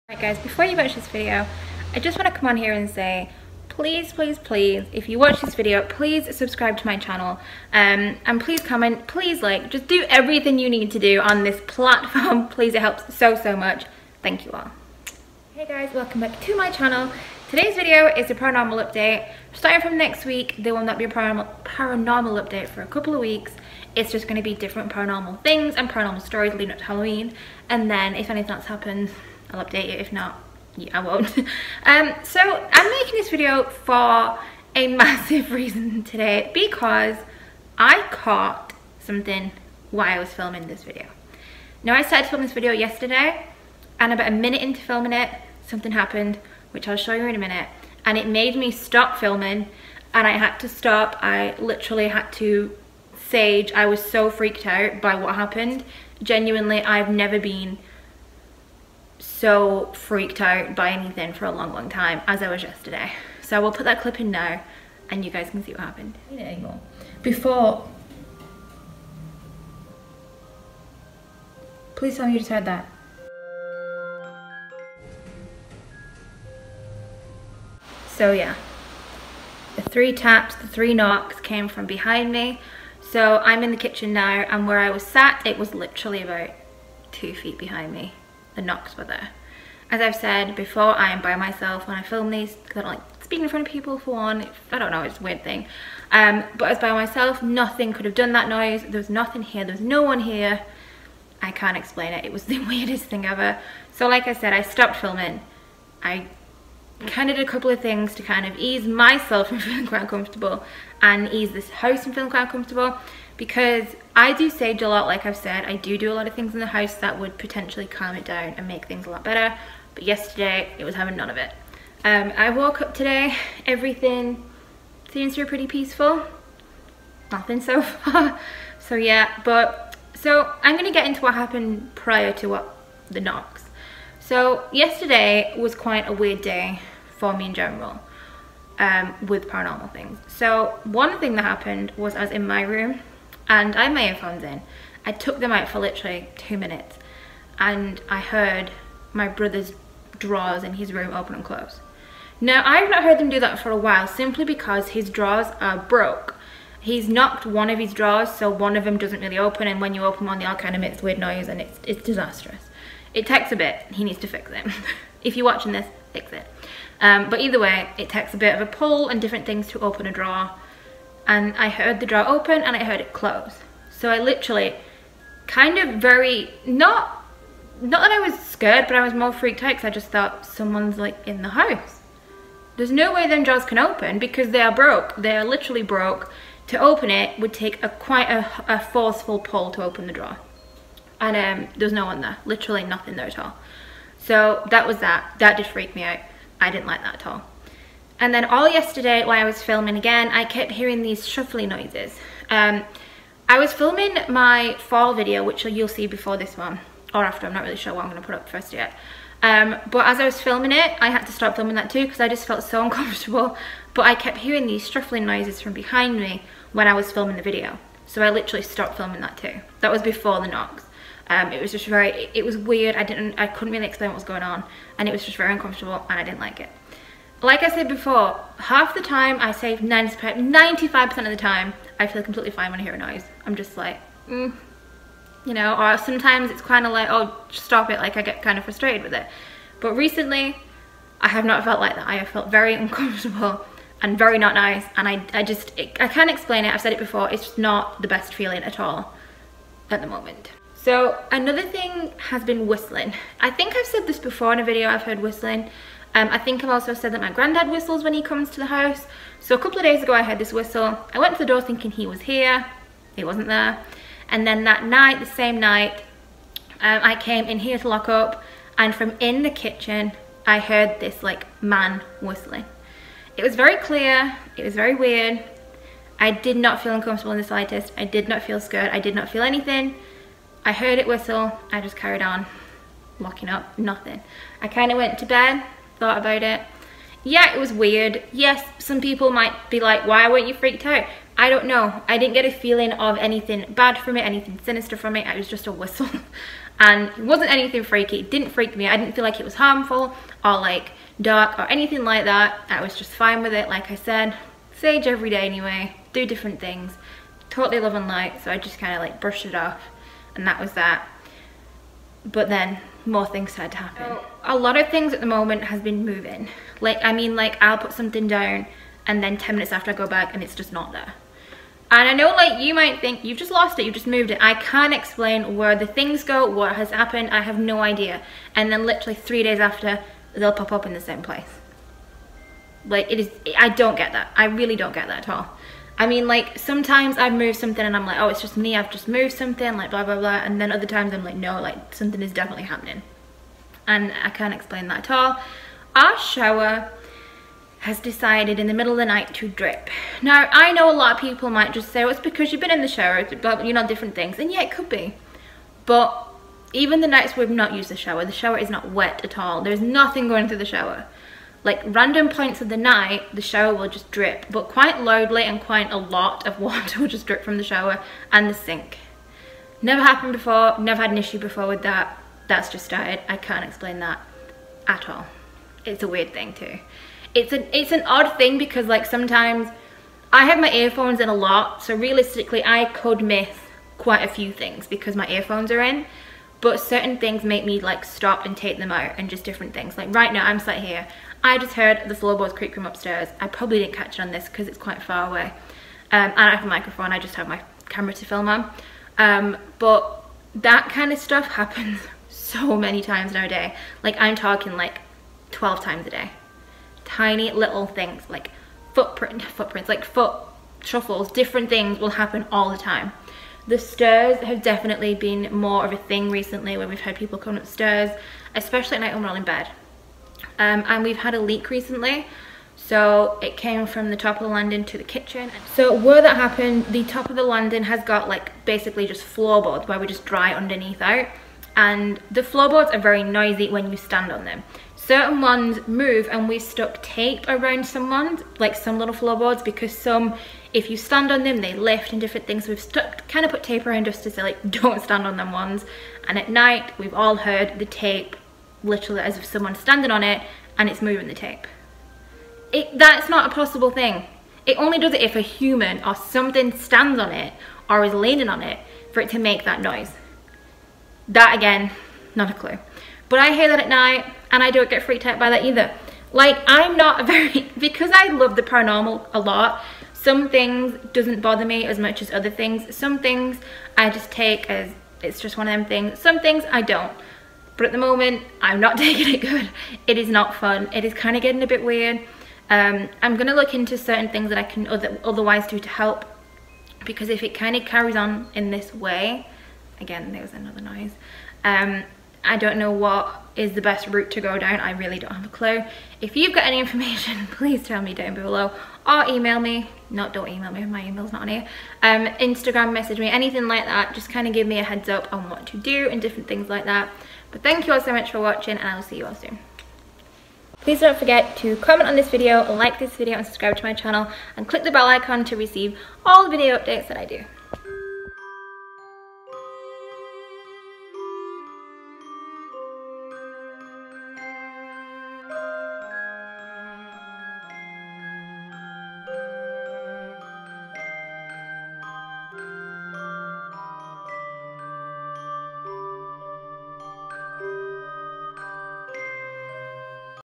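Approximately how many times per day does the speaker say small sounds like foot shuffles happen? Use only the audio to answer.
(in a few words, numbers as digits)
12.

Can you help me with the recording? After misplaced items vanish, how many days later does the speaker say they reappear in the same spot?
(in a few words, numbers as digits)
3 days.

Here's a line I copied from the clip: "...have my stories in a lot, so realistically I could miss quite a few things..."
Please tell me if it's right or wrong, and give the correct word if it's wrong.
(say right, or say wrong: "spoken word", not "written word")
wrong: "earphones", not "stories".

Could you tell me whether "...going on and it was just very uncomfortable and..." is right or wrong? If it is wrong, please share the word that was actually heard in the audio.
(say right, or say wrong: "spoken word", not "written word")
right.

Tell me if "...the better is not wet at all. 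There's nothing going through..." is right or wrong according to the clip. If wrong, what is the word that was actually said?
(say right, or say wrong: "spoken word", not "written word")
wrong: "shower", not "better".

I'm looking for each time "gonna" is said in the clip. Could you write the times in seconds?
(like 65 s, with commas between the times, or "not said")
208 s, 483 s.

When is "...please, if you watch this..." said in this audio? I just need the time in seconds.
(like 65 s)
4 s.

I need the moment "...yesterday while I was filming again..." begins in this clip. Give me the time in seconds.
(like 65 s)
198 s.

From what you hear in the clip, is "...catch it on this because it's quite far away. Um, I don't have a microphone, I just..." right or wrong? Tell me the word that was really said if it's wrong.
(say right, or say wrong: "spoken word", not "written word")
right.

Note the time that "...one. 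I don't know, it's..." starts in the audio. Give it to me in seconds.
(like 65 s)
94 s.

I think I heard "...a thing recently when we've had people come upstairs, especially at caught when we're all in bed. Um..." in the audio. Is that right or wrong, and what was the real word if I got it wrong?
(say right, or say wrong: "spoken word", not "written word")
wrong: "night", not "caught".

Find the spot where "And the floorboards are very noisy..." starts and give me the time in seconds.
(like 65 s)
431 s.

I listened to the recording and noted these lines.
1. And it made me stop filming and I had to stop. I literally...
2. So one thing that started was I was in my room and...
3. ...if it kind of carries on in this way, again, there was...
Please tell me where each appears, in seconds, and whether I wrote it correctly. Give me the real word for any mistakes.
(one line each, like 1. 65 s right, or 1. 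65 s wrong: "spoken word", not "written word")
1. 48 s right
2. 140 s wrong: "happened", not "started"
3. 487 s right.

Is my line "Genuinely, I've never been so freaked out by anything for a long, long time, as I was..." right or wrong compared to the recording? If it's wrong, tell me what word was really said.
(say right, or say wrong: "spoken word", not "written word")
right.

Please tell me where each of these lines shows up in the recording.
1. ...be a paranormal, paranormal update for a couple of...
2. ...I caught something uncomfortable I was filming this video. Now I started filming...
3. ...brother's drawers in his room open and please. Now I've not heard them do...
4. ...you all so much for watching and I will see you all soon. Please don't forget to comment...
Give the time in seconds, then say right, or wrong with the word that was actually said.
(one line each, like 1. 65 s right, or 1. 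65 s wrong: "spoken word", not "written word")
1. 20 s right
2. 37 s wrong: "while", not "uncomfortable"
3. 149 s wrong: "close", not "please"
4. 507 s right.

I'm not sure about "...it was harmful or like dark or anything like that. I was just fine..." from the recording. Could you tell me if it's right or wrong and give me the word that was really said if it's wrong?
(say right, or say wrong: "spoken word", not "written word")
right.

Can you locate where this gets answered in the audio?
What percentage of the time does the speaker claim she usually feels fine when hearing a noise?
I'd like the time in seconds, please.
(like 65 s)
229 s.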